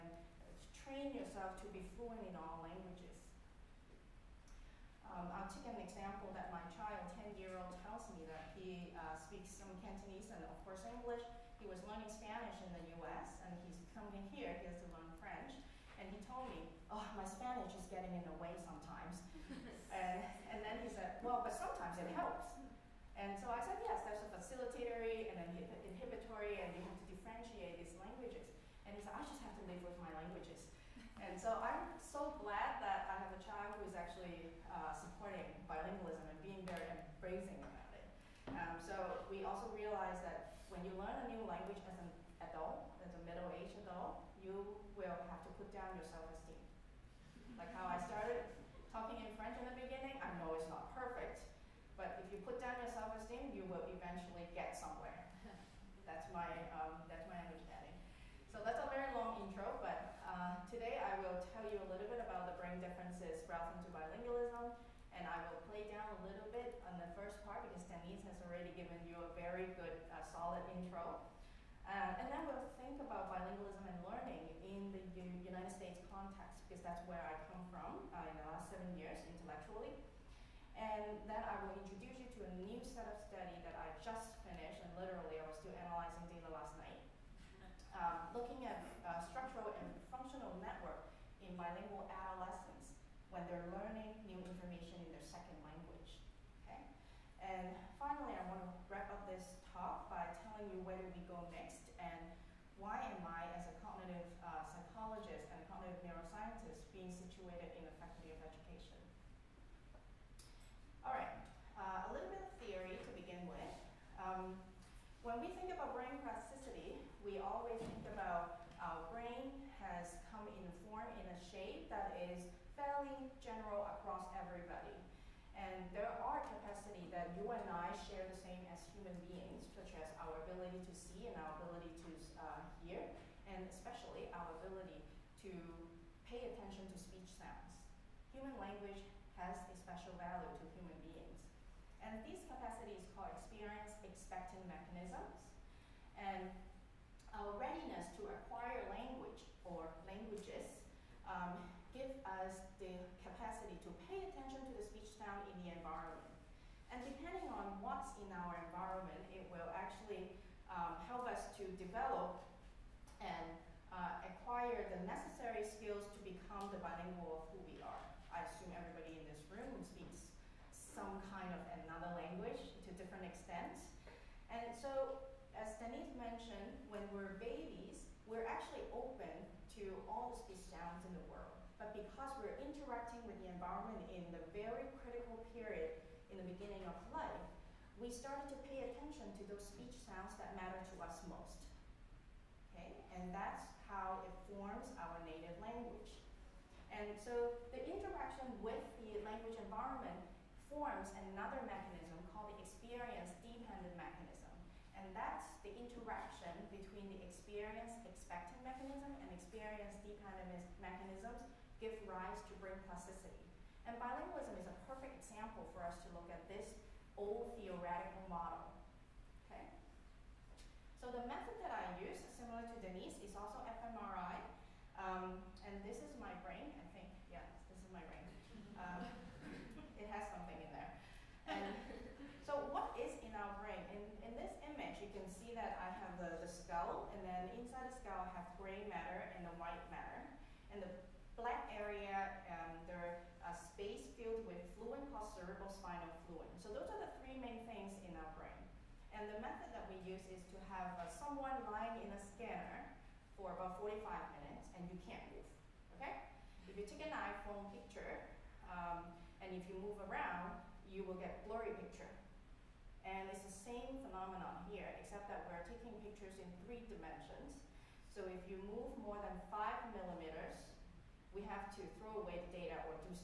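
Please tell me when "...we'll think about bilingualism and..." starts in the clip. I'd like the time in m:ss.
1:12.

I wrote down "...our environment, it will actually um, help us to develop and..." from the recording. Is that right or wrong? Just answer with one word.
right.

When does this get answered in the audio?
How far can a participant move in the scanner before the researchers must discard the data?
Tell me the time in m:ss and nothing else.
4:29.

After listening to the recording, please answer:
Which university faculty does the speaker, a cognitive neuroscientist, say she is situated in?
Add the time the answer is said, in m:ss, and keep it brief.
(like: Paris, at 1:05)
Faculty of Education, at 1:48.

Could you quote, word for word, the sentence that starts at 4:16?
If you take an iPhone picture, um, and if you move around, you will get blurry picture.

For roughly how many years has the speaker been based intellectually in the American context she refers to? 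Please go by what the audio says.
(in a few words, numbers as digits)
7.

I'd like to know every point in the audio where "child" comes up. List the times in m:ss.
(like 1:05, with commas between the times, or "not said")
0:06, 0:33.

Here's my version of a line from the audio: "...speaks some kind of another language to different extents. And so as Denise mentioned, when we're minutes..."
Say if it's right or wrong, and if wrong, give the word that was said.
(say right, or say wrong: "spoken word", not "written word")
wrong: "babies", not "minutes".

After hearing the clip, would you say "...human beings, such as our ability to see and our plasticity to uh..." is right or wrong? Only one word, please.
wrong.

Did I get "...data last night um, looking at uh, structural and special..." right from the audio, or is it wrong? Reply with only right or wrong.
wrong.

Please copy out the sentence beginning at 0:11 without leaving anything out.
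He was learning Spanish in the U.S., and he's coming here.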